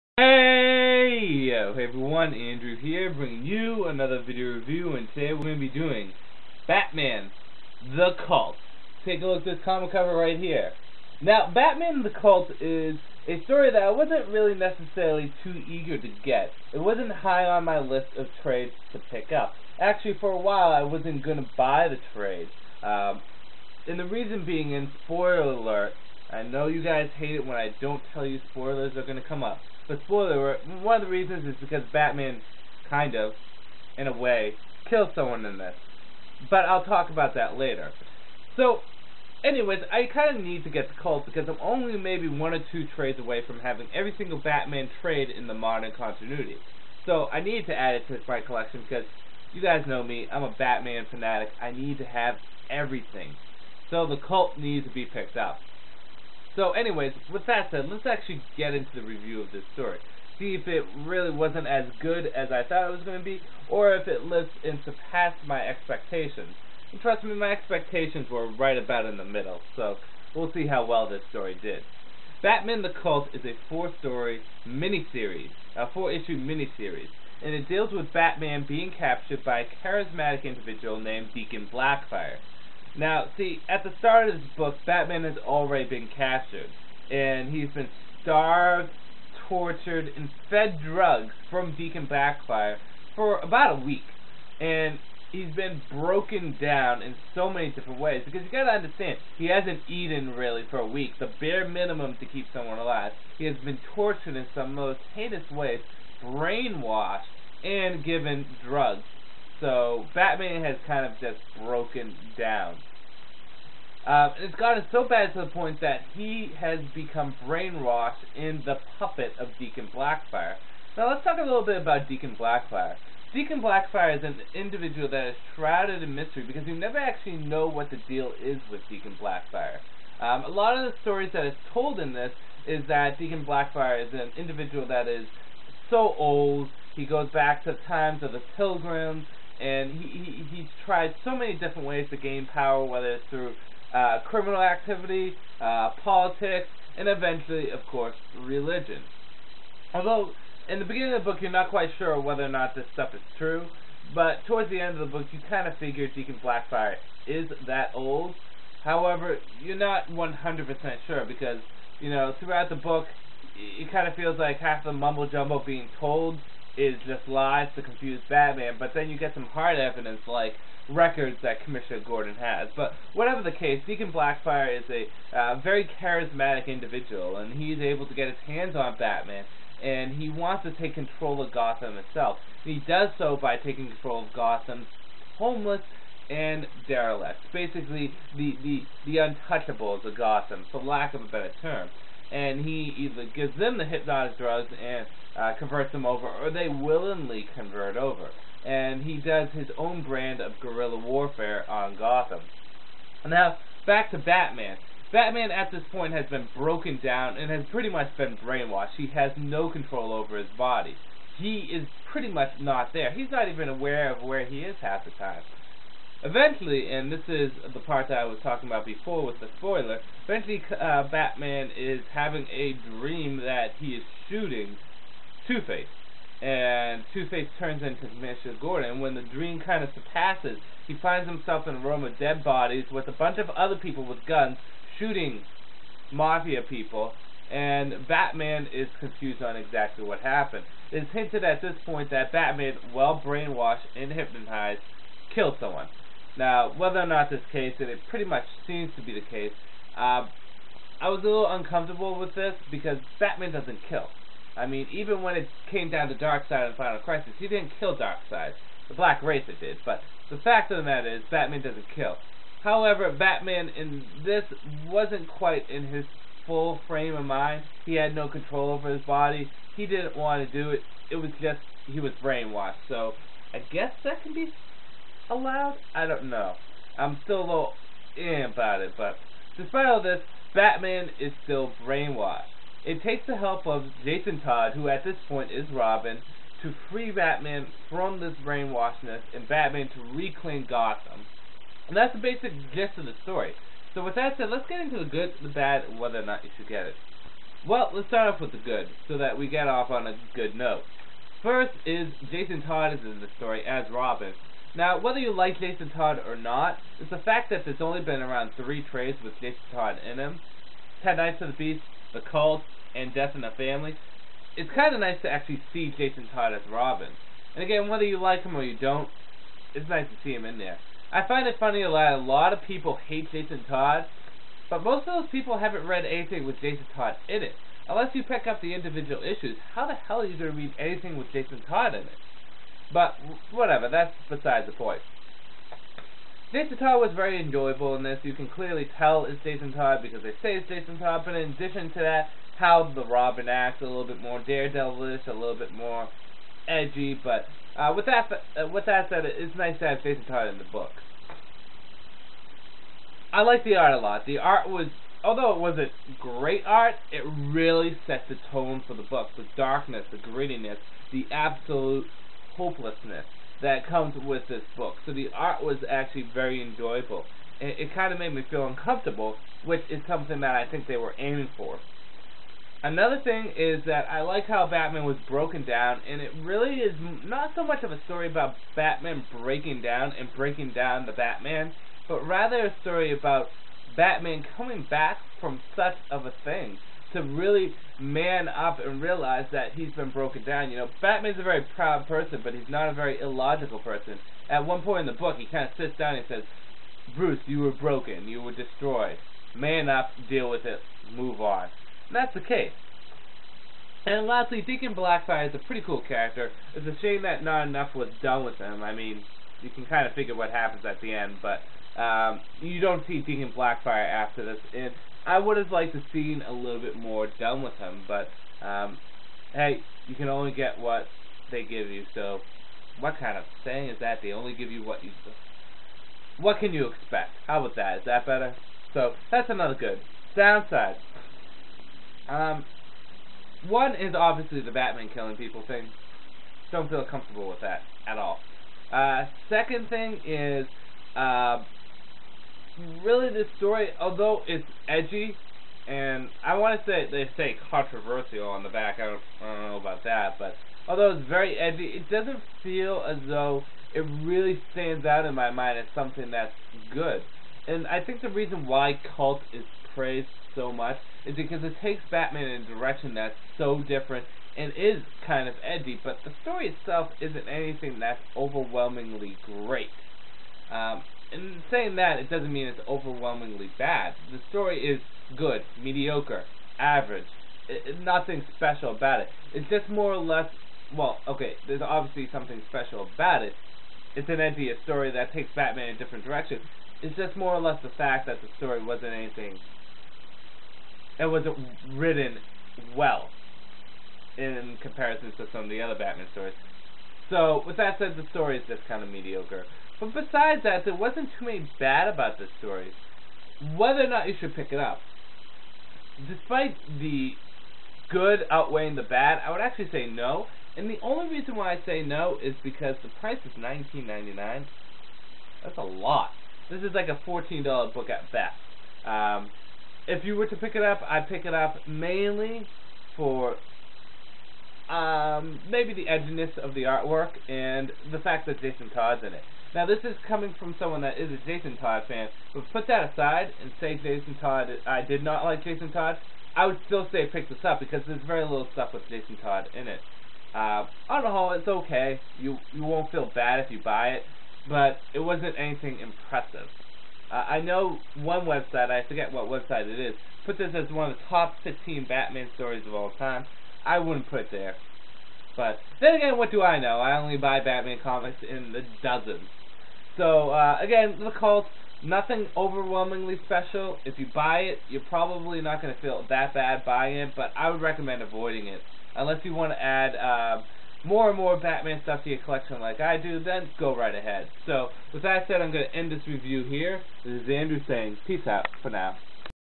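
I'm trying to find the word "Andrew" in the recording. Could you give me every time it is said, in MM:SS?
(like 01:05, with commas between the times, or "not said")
00:02, 09:37.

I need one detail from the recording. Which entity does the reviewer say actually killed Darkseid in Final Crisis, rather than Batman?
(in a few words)
The Black Racer.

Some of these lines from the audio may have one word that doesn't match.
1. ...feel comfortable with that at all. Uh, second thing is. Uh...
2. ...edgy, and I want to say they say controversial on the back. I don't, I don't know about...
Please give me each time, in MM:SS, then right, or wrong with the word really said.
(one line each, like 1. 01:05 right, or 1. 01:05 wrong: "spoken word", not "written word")
1. 07:16 right
2. 07:24 right.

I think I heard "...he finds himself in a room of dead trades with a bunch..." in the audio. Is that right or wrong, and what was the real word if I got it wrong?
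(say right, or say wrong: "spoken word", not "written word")
wrong: "bodies", not "trades".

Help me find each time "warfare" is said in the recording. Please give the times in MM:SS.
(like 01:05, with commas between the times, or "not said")
03:20.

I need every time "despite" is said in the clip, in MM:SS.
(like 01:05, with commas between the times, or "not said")
04:39, 08:26.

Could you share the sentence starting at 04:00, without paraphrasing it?
It's hinted at this point that Batman, well brainwashed and hypnotized, killed someone.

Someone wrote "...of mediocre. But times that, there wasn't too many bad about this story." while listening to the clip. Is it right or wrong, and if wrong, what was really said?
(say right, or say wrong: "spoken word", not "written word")
wrong: "besides", not "times".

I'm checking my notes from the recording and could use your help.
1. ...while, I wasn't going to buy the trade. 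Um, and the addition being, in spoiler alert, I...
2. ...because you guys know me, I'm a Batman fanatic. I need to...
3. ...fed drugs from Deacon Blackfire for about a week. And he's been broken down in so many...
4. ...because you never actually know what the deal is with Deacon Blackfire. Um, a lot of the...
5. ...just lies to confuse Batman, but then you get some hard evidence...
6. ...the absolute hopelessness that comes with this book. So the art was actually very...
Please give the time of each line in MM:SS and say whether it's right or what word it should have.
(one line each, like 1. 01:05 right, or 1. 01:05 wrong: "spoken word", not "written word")
1. 00:20 wrong: "reason", not "addition"
2. 00:48 right
3. 01:30 right
4. 02:06 right
5. 02:47 right
6. 06:01 right.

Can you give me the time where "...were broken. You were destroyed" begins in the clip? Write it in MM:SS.
06:37.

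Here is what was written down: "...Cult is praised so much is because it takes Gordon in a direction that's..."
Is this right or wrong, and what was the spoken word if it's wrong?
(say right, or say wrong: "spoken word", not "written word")
wrong: "Batman", not "Gordon".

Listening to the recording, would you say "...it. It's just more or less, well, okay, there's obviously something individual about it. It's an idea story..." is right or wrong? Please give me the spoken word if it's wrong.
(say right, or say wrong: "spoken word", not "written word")
wrong: "special", not "individual".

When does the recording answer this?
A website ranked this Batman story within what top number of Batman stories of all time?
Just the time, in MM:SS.
09:11.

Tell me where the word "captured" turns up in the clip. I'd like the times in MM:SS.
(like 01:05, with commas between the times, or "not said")
01:18, 01:26.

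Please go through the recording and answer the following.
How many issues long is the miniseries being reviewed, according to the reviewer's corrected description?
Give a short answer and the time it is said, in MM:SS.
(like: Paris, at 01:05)
4, at 01:15.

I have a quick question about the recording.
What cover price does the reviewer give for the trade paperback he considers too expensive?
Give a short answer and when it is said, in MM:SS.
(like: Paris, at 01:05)
$19.99, at 08:33.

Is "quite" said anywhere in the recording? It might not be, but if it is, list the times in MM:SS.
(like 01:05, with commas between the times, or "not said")
02:31, 04:25.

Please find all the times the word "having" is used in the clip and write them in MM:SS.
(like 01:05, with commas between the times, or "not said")
00:43, 03:42.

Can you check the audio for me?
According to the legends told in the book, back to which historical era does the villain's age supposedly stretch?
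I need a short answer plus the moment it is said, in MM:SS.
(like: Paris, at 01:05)
The pilgrims, at 02:18.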